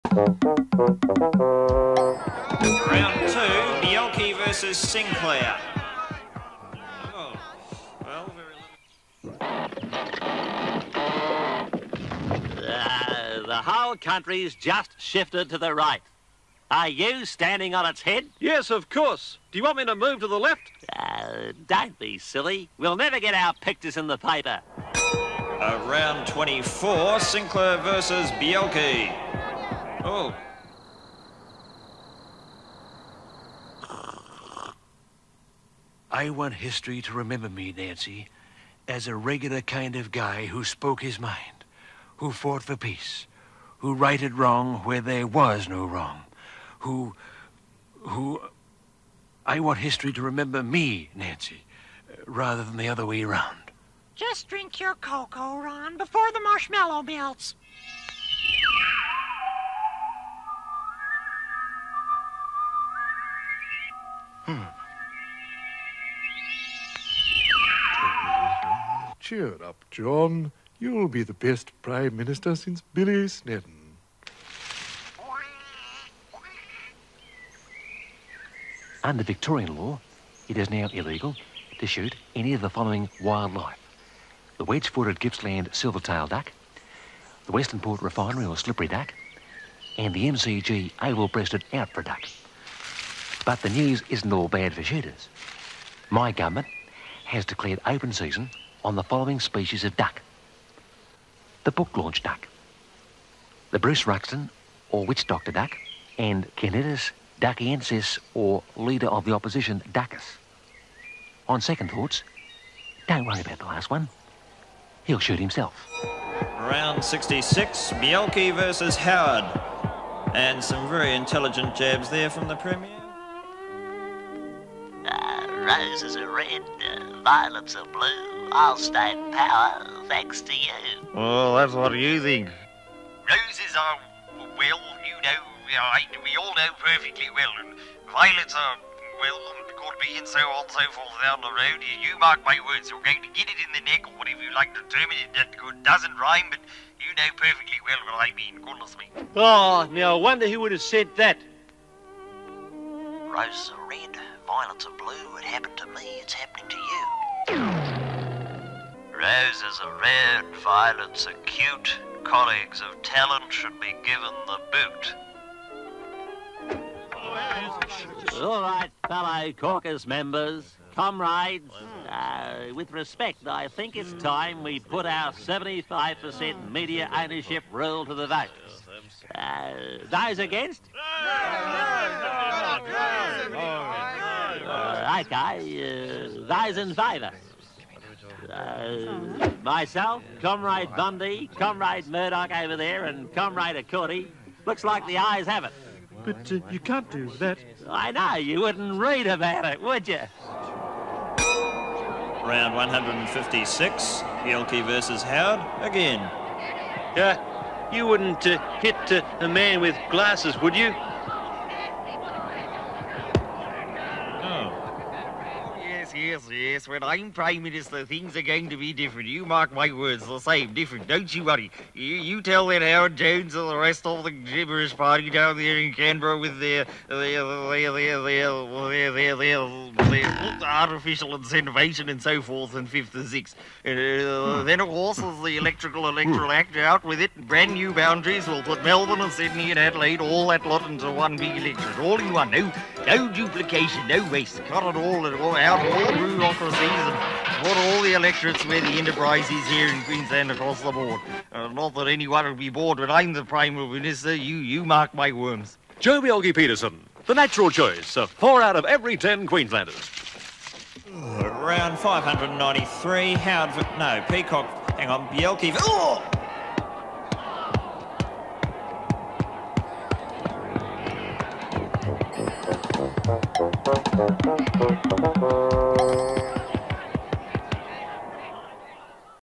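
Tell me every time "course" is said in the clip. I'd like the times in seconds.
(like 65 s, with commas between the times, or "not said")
18 s, 234 s.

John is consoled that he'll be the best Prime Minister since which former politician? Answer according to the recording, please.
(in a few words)
Billy Snedden.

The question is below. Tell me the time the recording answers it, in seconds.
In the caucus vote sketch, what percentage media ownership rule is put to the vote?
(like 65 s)
175 s.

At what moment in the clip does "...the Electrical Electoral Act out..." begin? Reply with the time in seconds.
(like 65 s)
235 s.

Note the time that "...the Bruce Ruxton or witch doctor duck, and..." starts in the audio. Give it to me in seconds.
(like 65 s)
103 s.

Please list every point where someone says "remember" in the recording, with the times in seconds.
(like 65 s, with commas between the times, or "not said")
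37 s, 50 s.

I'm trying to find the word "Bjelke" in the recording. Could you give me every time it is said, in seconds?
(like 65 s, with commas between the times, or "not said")
3 s, 28 s, 117 s, 204 s, 256 s, 265 s.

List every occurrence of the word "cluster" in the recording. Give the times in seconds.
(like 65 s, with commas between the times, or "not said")
not said.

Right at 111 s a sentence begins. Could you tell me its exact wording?
On second thoughts, don't worry about the last one.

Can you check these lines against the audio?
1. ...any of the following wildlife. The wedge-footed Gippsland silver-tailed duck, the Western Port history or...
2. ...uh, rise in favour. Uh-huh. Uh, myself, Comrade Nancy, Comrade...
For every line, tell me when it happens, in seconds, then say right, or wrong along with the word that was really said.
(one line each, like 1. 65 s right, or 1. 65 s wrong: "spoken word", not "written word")
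1. 82 s wrong: "refinery", not "history"
2. 186 s wrong: "Bundy", not "Nancy".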